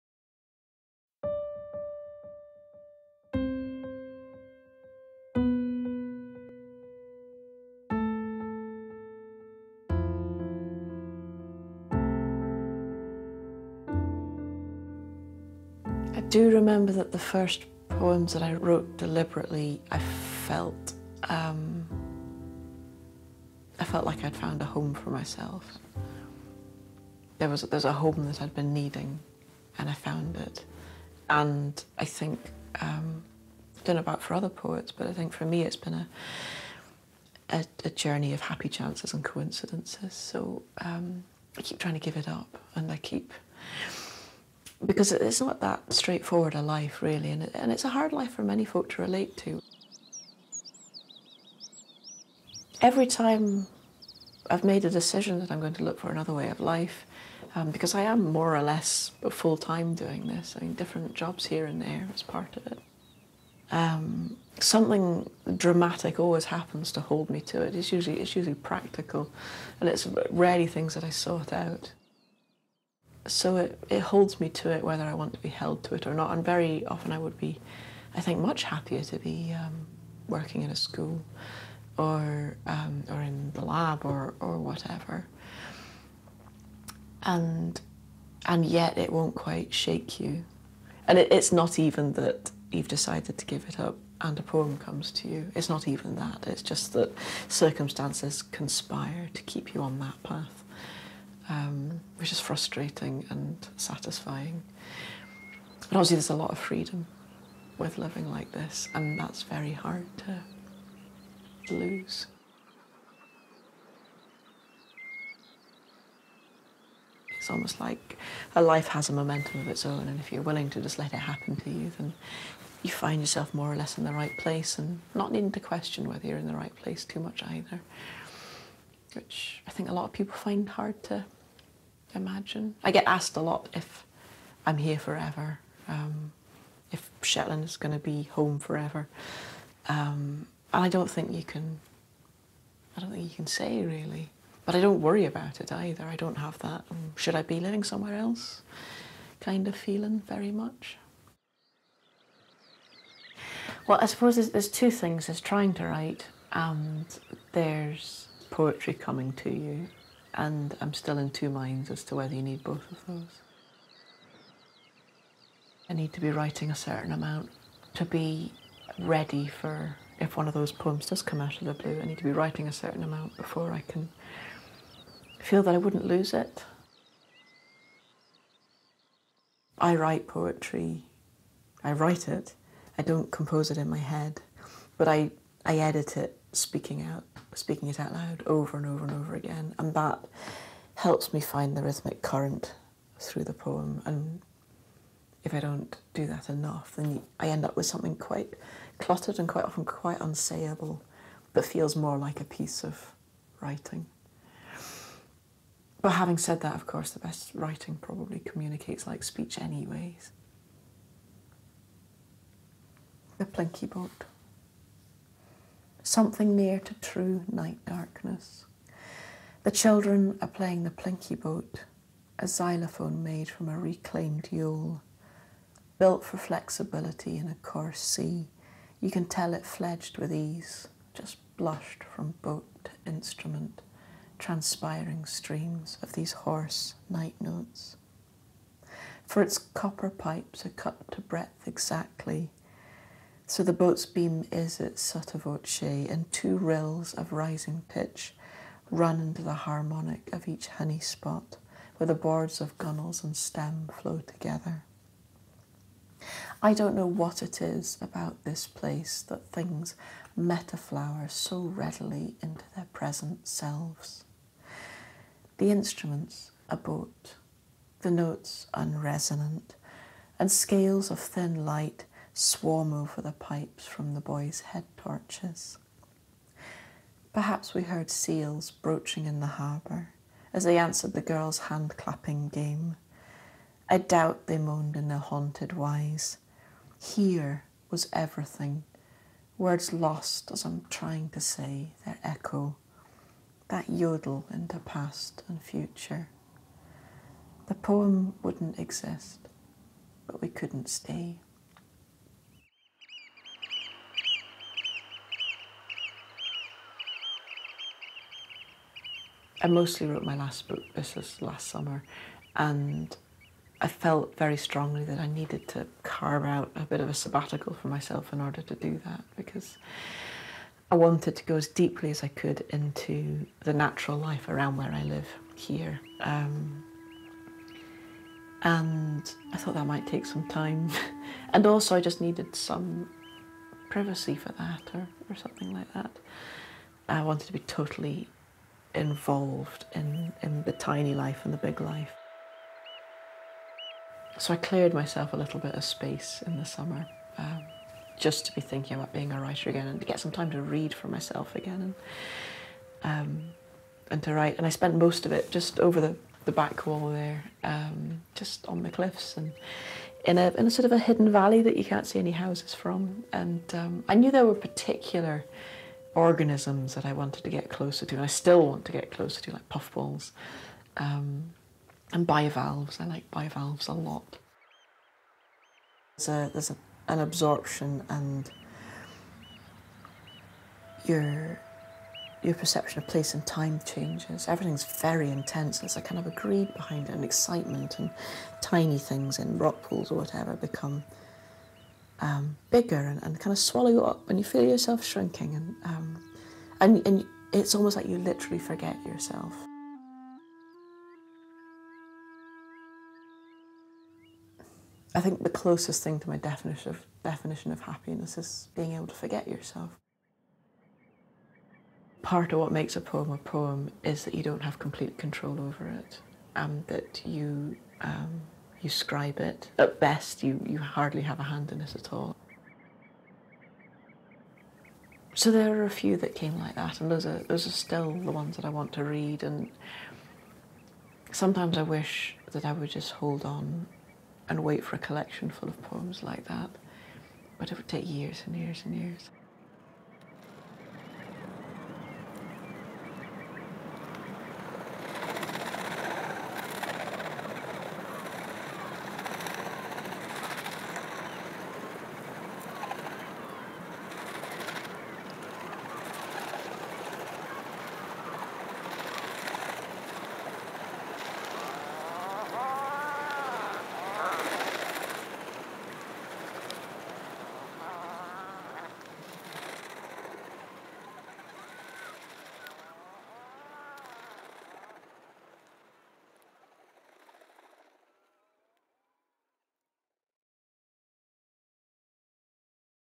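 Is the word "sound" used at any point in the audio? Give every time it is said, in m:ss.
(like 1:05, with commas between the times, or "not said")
not said.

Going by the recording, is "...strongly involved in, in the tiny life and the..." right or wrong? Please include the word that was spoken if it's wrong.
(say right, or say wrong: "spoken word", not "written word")
wrong: "totally", not "strongly".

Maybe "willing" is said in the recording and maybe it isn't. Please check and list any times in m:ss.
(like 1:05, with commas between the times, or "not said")
2:00.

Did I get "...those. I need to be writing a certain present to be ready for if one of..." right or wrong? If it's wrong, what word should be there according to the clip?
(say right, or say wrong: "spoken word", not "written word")
wrong: "amount", not "present".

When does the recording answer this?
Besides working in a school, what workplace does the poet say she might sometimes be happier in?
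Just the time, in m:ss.
1:23.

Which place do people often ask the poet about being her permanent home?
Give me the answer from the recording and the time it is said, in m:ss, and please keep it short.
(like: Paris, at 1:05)
Shetland, at 2:17.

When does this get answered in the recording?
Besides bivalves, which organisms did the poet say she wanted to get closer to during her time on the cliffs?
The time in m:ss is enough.
6:09.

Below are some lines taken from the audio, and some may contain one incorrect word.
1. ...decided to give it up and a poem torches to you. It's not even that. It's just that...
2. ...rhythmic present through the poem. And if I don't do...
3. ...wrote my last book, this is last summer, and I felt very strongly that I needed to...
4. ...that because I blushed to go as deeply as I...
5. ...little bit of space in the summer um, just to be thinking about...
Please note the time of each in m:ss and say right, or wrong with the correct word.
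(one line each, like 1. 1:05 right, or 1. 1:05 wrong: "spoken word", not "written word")
1. 1:32 wrong: "comes", not "torches"
2. 3:11 wrong: "current", not "present"
3. 5:10 right
4. 5:19 wrong: "wanted", not "blushed"
5. 5:45 right.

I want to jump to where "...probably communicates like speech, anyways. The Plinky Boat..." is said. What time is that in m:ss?
3:28.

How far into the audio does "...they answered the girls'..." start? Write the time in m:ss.
4:40.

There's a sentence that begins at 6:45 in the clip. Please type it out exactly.
I think the closest thing to my definition of, definition of happiness is being able to forget yourself.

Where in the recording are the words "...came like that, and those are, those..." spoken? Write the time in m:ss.
7:06.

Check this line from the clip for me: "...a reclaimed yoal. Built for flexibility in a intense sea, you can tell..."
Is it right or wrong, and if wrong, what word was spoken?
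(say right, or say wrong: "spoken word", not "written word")
wrong: "coarse", not "intense".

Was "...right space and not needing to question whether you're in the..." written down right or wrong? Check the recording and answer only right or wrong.
wrong.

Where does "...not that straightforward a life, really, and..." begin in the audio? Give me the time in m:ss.
0:45.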